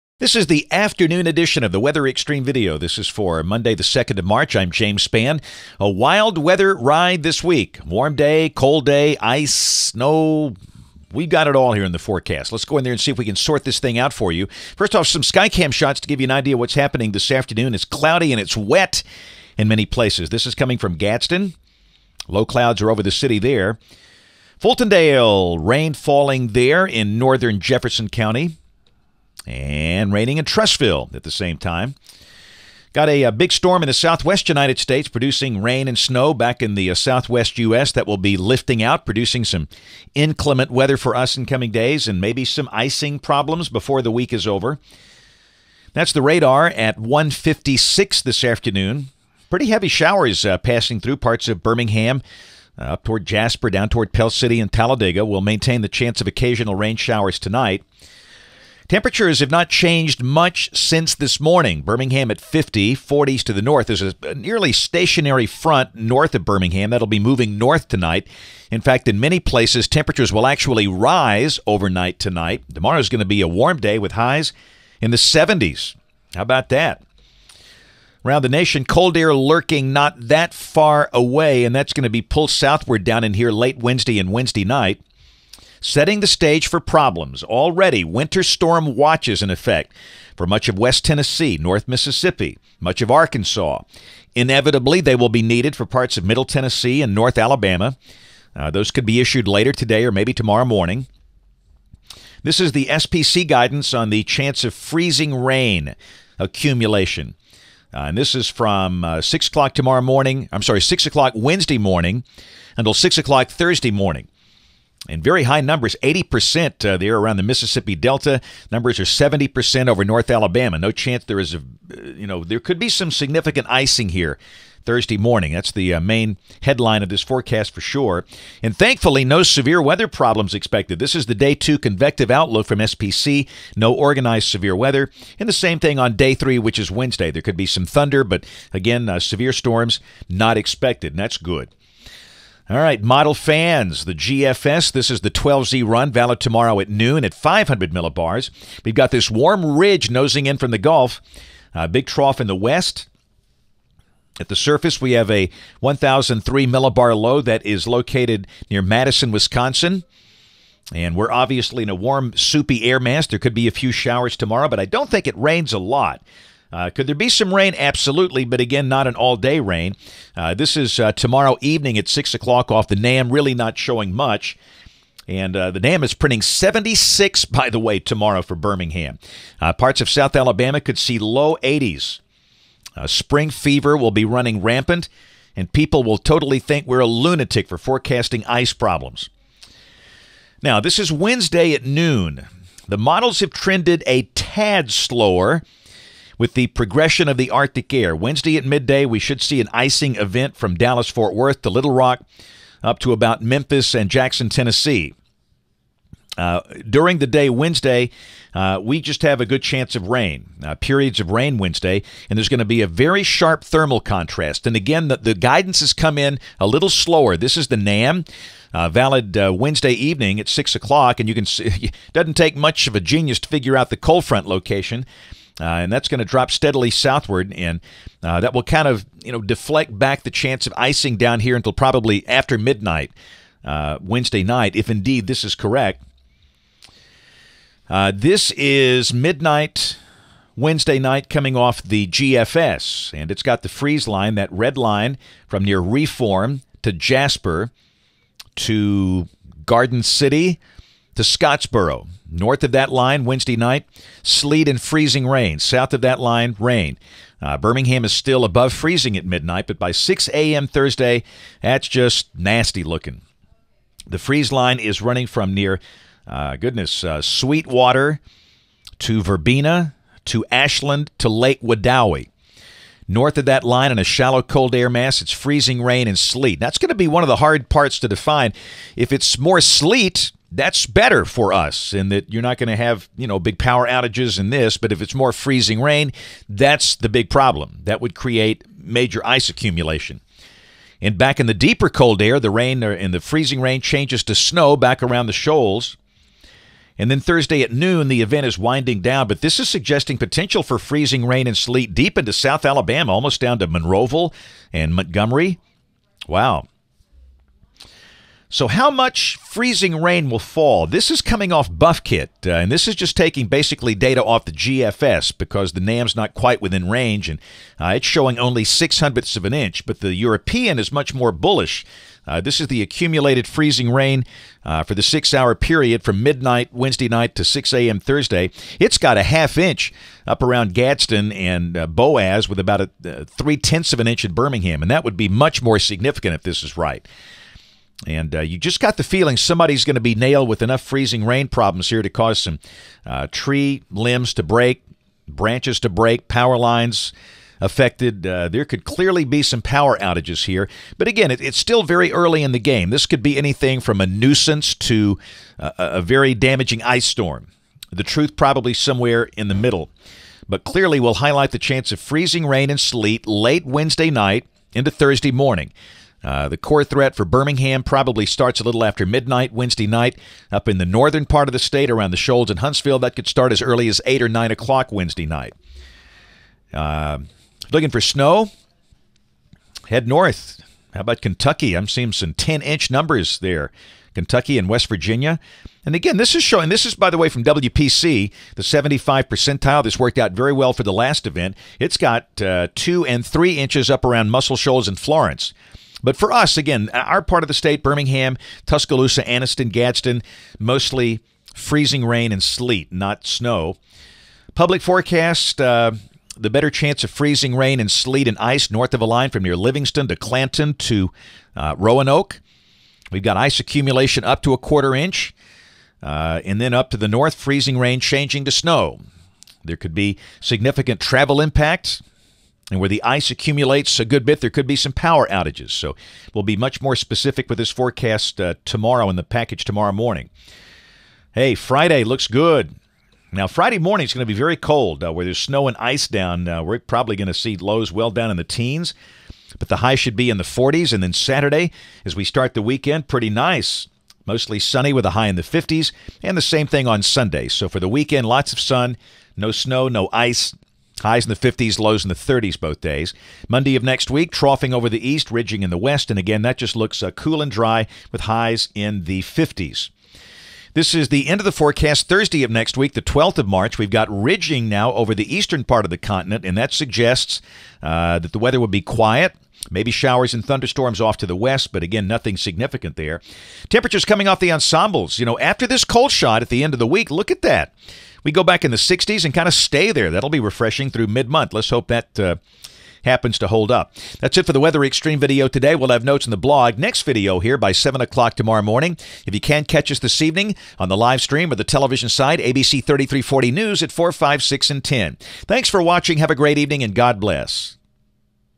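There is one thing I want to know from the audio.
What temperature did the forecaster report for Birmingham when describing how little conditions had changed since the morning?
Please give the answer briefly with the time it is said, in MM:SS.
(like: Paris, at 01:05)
50, at 01:01.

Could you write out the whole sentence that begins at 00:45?
That's the radar at 156 this afternoon.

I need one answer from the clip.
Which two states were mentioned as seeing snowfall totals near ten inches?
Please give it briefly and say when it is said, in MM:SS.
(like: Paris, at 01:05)
Kentucky and West Virginia, at 06:24.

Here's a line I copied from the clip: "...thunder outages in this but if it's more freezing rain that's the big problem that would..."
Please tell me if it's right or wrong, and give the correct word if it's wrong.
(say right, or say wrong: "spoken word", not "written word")
wrong: "power", not "thunder".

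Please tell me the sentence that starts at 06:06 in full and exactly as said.
Uh, the core threat for Birmingham probably starts a little after midnight Wednesday night.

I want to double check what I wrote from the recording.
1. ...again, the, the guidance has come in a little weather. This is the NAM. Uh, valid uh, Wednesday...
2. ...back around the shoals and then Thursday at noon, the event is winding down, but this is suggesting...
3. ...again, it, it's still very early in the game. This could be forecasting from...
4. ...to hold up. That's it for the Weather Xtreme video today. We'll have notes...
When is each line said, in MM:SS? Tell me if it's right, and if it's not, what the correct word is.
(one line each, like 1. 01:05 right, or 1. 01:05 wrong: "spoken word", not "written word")
1. 03:34 wrong: "slower", not "weather"
2. 04:54 right
3. 05:51 wrong: "anything", not "forecasting"
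4. 08:03 right.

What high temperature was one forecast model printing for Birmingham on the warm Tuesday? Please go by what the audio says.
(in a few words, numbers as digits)
76.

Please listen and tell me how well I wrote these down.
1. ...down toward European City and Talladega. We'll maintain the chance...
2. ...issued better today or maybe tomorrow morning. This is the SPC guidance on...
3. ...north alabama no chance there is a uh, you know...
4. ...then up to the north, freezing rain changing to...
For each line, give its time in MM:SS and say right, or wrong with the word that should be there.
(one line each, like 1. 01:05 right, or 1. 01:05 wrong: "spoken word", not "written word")
1. 00:53 wrong: "Pell", not "European"
2. 01:39 wrong: "later", not "better"
3. 02:00 right
4. 06:56 right.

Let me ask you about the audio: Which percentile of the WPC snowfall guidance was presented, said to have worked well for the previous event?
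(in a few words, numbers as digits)
75th percentile.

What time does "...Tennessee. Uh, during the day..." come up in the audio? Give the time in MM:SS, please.
03:24.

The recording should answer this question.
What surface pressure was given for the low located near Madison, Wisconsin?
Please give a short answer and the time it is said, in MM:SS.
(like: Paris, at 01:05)
1,003 millibars, at 02:35.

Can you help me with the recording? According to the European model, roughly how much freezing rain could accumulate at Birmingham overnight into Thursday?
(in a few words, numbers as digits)
0.3 inch.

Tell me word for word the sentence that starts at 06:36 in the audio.
But for us, again, our part of the state, Birmingham, Tuscaloosa, Anniston, Gadsden, mostly freezing rain and sleet, not snow.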